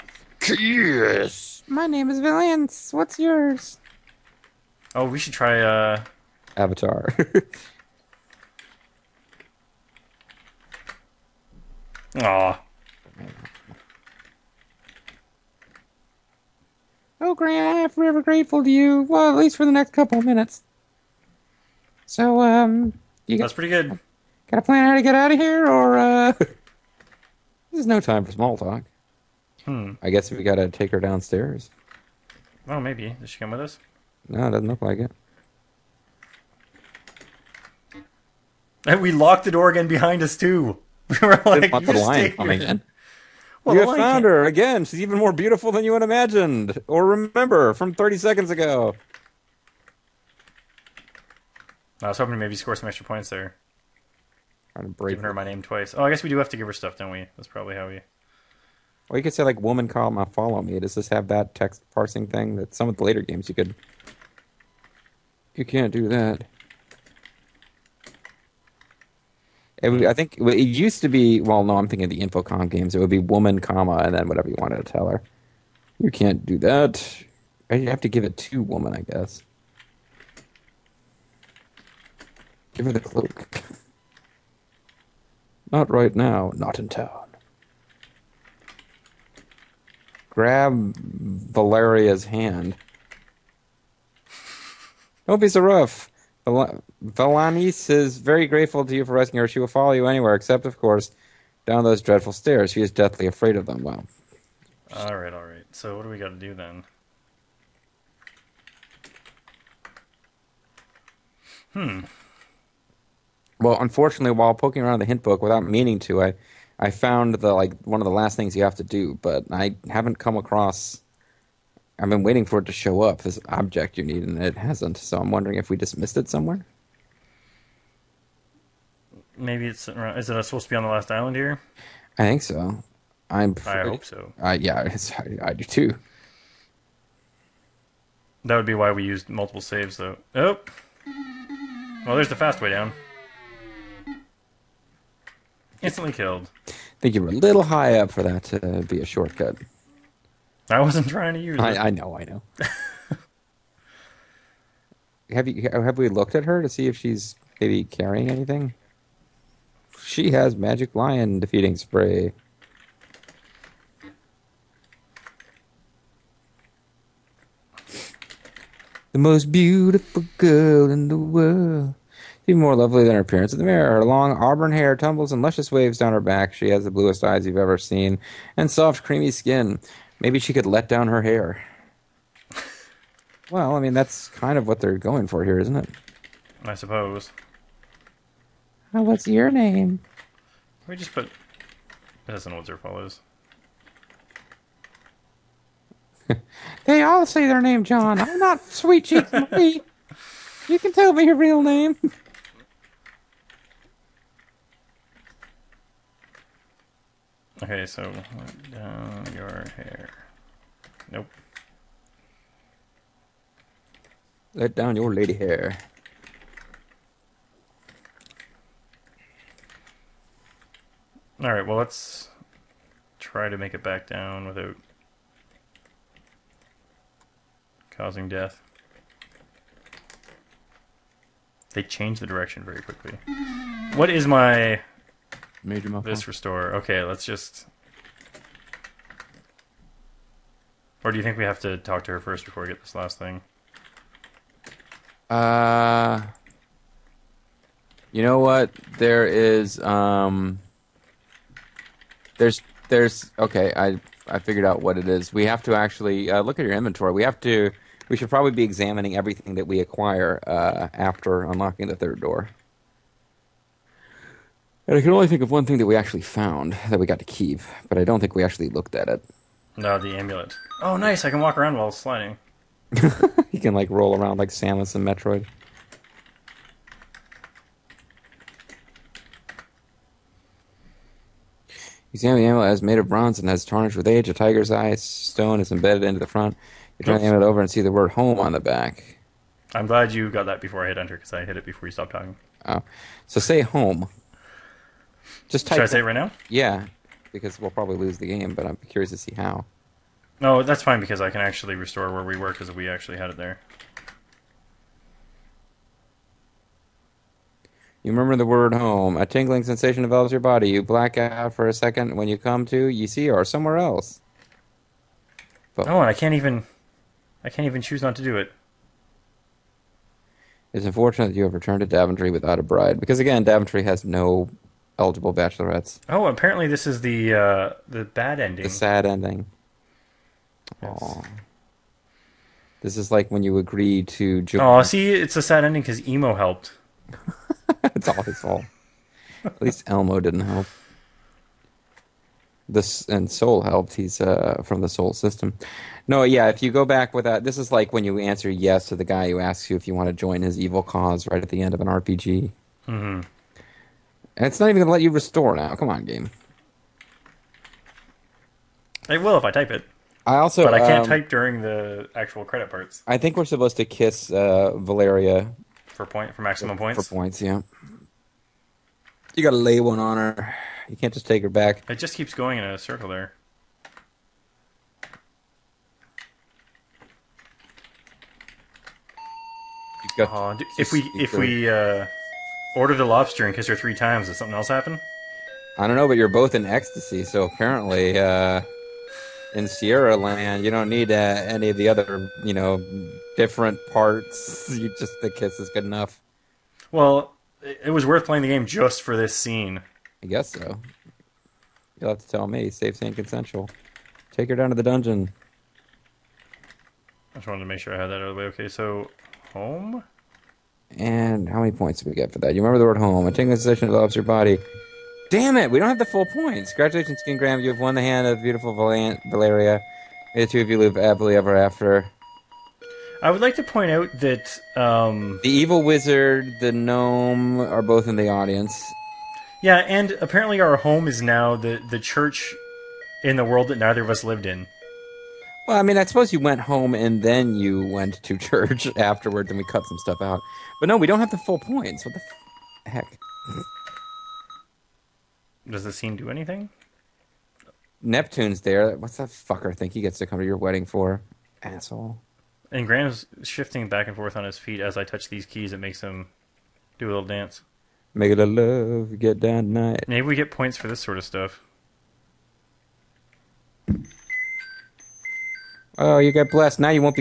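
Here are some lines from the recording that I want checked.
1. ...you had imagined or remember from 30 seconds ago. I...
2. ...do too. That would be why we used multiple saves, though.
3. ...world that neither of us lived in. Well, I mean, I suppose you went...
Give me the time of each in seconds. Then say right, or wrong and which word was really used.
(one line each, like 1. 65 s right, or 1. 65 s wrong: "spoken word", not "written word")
1. 45 s right
2. 135 s right
3. 433 s right.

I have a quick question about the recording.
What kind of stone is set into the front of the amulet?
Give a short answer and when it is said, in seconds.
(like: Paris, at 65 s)
Tiger's eye, at 284 s.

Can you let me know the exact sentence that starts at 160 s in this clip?
She has magic lion defeating spray.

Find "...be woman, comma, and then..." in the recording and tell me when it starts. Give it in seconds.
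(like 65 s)
73 s.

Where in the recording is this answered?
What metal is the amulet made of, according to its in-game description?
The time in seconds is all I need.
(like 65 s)
283 s.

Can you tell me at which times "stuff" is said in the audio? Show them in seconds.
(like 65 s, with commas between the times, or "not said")
56 s, 439 s, 461 s.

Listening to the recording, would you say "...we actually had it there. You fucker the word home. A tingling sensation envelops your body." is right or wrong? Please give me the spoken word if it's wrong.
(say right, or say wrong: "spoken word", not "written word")
wrong: "remember", not "fucker".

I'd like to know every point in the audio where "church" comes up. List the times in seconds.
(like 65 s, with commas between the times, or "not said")
431 s, 438 s.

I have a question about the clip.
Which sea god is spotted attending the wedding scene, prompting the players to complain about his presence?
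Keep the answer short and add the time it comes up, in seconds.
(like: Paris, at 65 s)
Neptune, at 448 s.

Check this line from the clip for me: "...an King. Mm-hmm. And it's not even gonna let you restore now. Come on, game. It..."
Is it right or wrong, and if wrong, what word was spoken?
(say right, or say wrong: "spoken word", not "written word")
wrong: "RPG", not "King".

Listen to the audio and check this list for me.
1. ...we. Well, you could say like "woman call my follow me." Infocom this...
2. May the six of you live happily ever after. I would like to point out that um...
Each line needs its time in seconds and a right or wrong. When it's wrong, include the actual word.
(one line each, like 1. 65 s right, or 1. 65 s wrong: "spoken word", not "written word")
1. 57 s wrong: "Does", not "Infocom"
2. 420 s wrong: "two", not "six".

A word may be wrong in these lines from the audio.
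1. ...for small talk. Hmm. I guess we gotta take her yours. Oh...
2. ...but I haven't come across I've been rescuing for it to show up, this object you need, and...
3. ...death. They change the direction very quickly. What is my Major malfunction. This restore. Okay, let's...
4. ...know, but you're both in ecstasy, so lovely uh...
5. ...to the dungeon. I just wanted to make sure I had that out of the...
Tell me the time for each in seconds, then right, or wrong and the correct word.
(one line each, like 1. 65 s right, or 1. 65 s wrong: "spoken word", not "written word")
1. 28 s wrong: "downstairs", not "yours"
2. 119 s wrong: "waiting", not "rescuing"
3. 228 s right
4. 385 s wrong: "apparently", not "lovely"
5. 404 s right.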